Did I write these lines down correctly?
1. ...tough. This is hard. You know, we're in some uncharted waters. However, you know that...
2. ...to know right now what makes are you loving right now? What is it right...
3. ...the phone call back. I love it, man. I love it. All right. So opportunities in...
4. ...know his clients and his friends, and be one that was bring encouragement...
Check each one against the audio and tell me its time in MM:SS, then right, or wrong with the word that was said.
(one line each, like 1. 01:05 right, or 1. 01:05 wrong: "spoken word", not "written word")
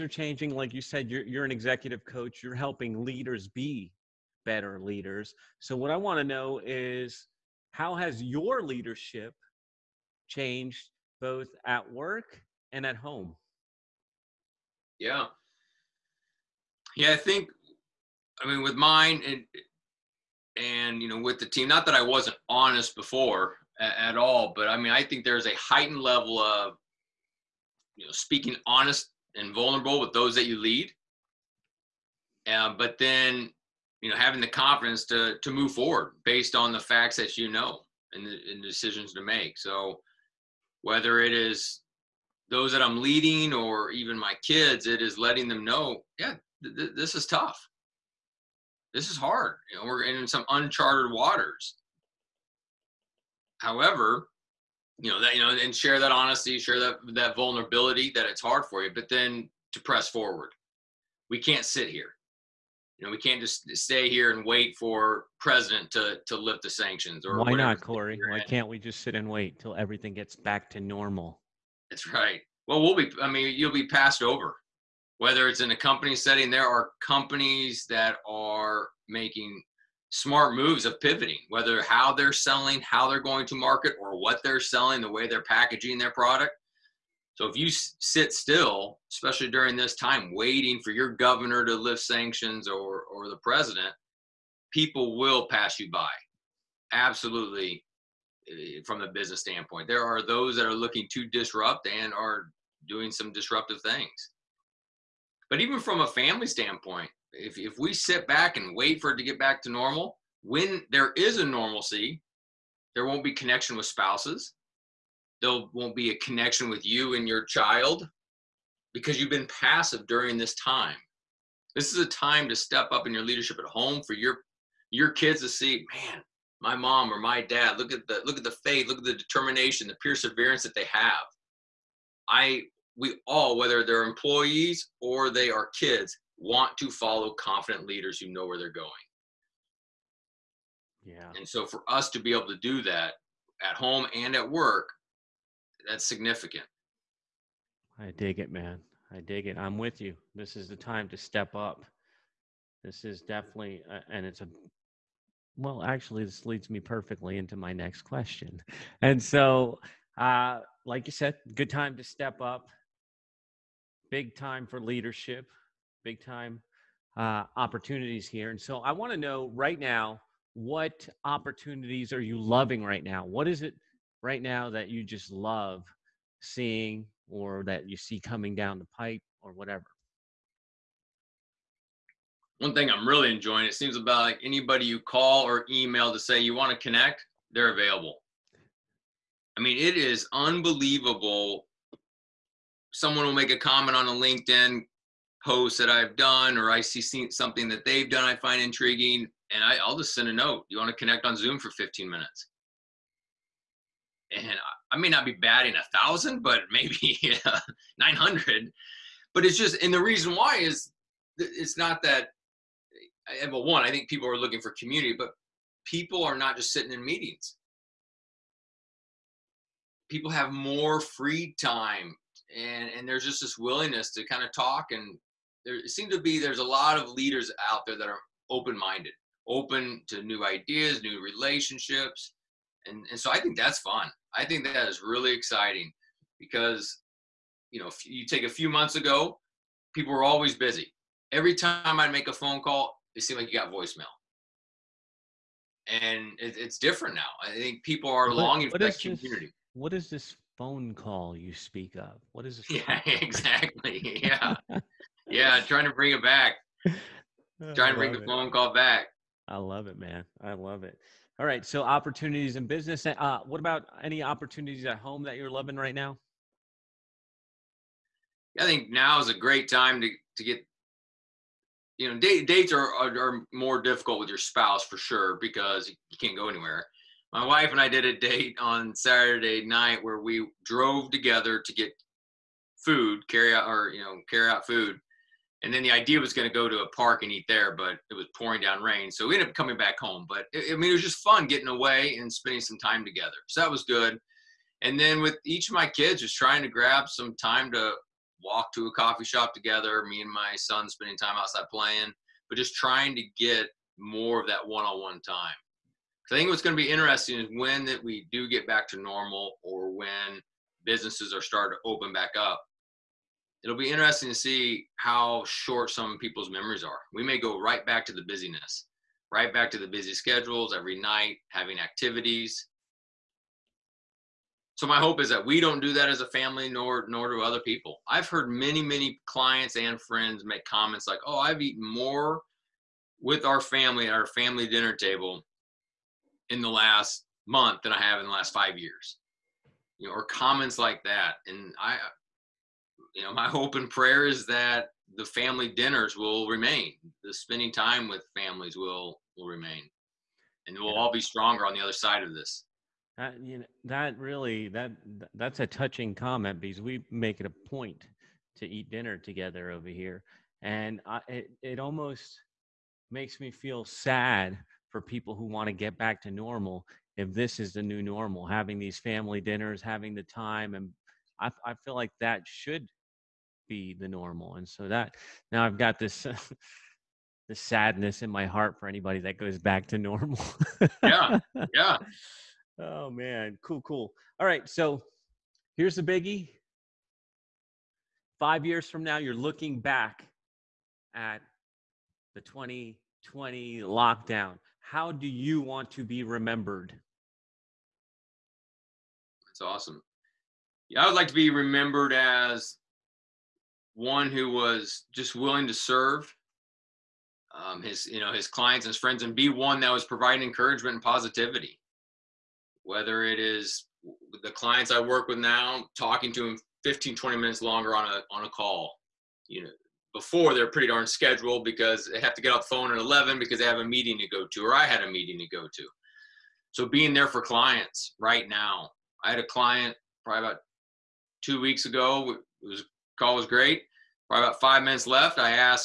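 1. 00:47 right
2. 02:49 wrong: "opportunities", not "makes"
3. 04:18 right
4. 06:48 wrong: "providing", not "bring".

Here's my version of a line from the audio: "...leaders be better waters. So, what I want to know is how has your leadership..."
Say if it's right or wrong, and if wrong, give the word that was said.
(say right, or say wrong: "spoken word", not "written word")
wrong: "leaders", not "waters".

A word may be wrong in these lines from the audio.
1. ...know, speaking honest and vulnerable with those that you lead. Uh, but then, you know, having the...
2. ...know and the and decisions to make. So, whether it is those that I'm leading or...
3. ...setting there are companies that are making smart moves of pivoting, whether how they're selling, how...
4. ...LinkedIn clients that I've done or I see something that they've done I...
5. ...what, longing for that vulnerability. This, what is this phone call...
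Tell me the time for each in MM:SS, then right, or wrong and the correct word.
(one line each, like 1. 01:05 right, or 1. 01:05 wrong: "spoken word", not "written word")
1. 00:28 right
2. 00:37 right
3. 01:16 right
4. 03:14 wrong: "posts", not "clients"
5. 04:08 wrong: "community", not "vulnerability".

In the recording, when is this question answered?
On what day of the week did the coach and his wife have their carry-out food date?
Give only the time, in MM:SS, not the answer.
04:38.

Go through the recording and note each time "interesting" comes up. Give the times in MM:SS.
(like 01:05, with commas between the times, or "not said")
05:06, 05:13.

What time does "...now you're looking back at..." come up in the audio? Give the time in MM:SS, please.
06:29.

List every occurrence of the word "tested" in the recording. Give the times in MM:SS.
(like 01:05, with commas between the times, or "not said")
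not said.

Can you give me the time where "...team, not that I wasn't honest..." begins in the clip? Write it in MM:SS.
00:21.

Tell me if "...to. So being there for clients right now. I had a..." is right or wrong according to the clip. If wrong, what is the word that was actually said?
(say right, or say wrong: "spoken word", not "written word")
right.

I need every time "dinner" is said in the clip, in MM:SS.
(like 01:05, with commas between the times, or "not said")
05:34, 05:45, 05:58, 06:09.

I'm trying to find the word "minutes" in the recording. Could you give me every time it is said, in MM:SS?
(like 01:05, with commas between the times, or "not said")
03:22, 06:57, 07:14.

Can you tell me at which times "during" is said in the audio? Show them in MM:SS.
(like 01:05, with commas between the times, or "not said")
01:29, 02:00.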